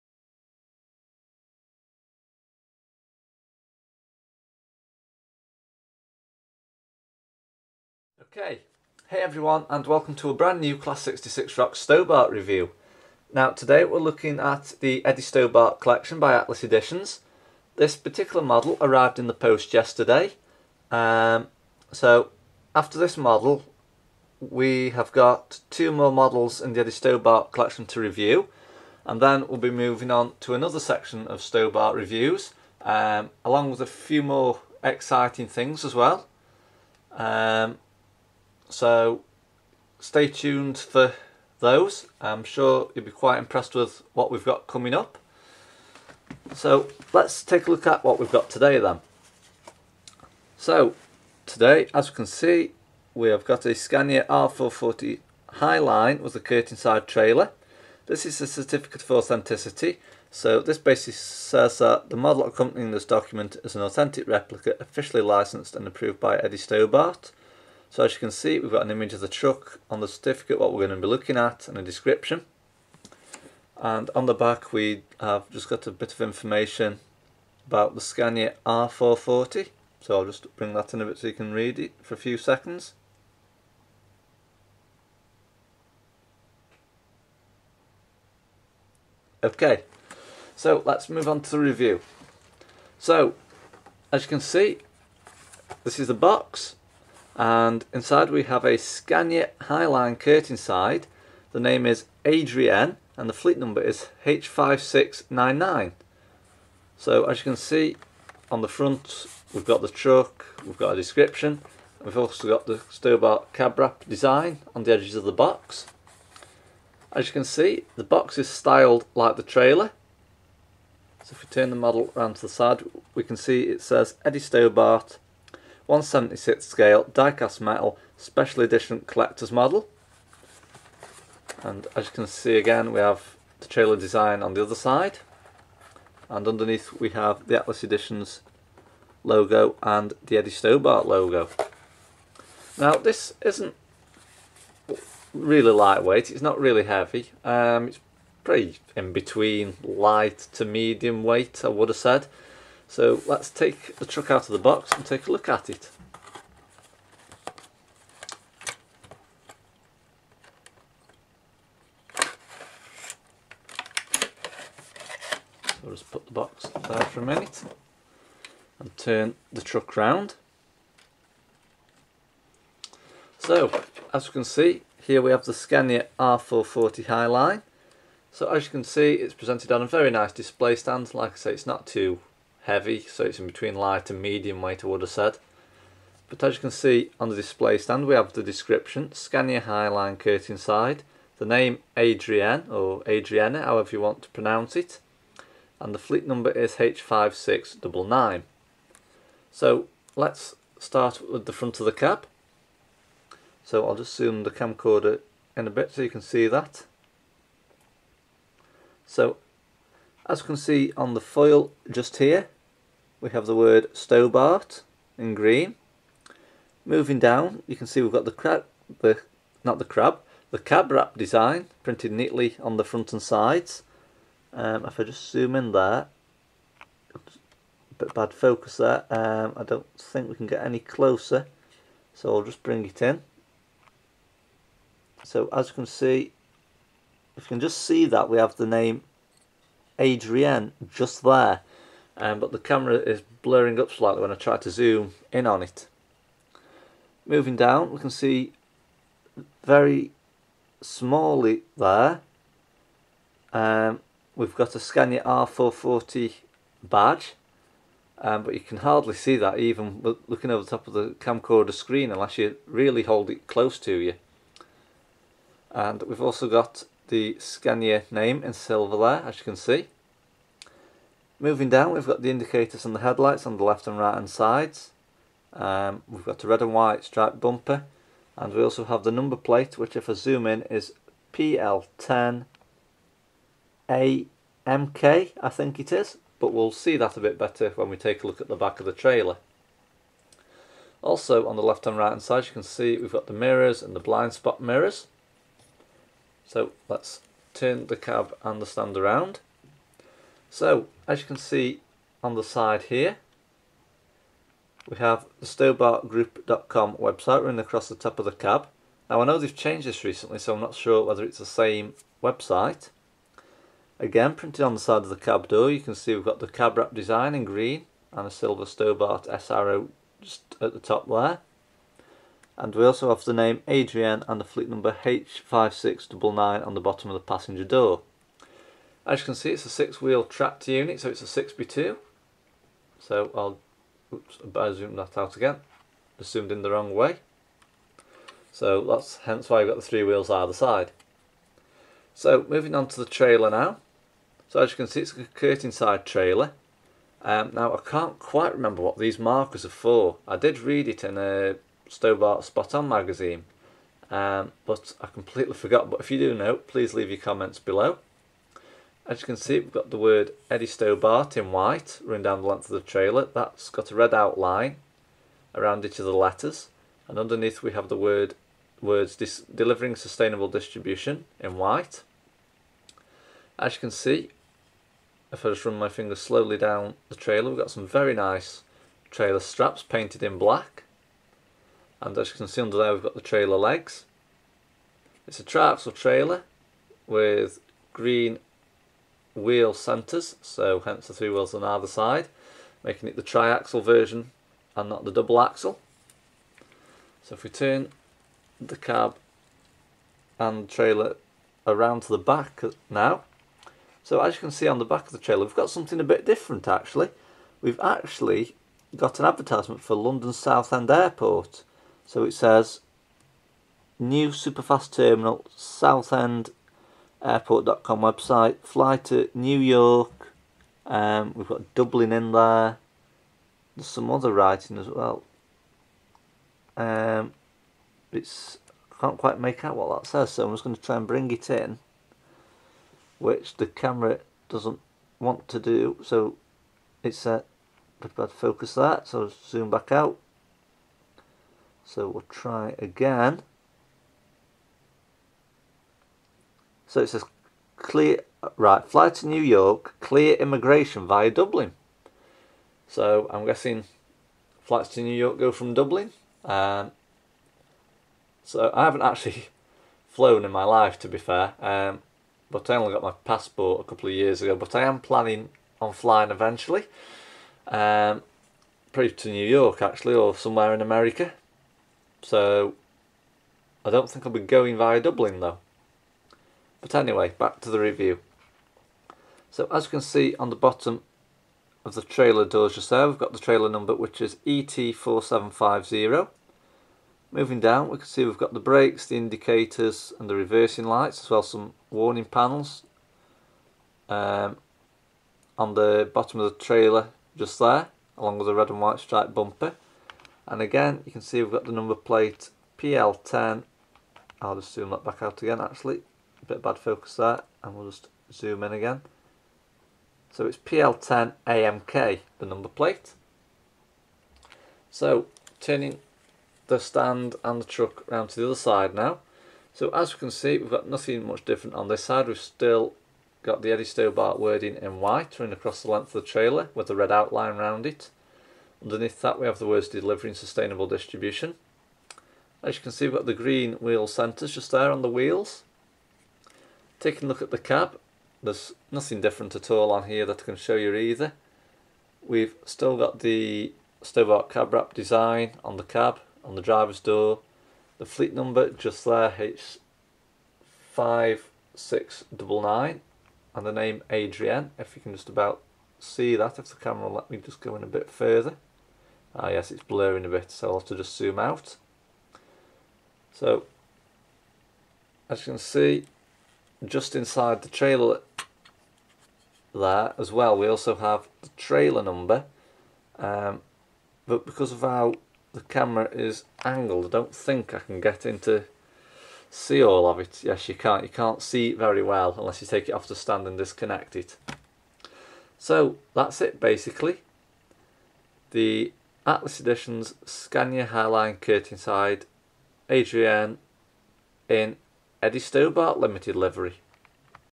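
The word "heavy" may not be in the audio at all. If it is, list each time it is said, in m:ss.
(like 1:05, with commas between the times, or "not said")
2:26, 3:02.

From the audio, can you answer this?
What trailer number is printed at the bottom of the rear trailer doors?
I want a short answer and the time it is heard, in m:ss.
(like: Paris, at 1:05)
ET4750, at 8:04.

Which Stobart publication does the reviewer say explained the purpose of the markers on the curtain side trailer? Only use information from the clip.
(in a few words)
Stobart Spot On.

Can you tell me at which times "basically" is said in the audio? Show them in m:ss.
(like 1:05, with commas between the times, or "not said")
1:00, 9:46.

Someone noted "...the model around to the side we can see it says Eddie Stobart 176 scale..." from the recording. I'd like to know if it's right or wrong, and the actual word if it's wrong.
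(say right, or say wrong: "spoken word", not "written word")
right.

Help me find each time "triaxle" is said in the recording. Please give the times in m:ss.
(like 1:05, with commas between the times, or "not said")
6:25, 6:33.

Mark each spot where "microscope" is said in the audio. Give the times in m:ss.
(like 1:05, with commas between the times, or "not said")
not said.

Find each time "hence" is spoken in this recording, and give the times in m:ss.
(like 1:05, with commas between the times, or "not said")
5:39, 6:30.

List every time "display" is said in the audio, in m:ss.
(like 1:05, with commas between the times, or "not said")
3:00, 3:07.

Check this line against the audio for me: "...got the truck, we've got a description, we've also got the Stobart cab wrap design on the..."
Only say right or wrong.
right.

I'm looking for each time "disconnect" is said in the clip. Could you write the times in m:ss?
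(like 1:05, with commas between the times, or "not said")
9:43.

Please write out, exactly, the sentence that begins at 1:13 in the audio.
And on the back, we have just got a bit of information about the Scania R440.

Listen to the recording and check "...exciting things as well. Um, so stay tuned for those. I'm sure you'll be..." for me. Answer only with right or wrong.
right.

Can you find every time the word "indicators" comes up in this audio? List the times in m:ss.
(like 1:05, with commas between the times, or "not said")
4:32, 8:09.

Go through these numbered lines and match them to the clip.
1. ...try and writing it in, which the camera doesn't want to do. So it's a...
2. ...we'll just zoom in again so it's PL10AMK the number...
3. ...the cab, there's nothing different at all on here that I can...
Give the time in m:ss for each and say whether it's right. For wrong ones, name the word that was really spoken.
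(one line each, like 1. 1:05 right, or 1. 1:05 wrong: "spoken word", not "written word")
1. 7:10 wrong: "bring", not "writing"
2. 8:27 right
3. 8:57 right.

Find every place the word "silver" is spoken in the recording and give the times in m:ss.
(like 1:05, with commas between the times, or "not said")
4:28, 5:18.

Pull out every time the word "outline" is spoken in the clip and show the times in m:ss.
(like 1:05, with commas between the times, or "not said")
6:04, 8:47.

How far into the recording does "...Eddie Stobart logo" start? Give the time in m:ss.
2:20.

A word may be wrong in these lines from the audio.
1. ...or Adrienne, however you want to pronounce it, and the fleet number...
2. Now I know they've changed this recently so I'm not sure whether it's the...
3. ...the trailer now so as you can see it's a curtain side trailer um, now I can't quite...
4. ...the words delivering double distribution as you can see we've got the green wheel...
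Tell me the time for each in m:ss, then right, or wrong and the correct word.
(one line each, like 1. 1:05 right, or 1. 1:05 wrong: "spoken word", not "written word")
1. 3:12 right
2. 5:09 right
3. 5:42 right
4. 8:49 wrong: "sustainable", not "double".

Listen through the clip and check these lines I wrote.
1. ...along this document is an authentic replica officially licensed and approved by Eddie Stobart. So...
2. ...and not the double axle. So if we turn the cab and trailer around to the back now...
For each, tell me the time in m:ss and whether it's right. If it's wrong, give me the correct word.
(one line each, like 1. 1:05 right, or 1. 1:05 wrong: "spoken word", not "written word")
1. 1:02 wrong: "accompanying", not "along"
2. 6:34 right.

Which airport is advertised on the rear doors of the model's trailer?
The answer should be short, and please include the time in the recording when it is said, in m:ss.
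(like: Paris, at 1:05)
London Southend Airport, at 6:49.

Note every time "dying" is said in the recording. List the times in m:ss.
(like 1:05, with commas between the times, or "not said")
not said.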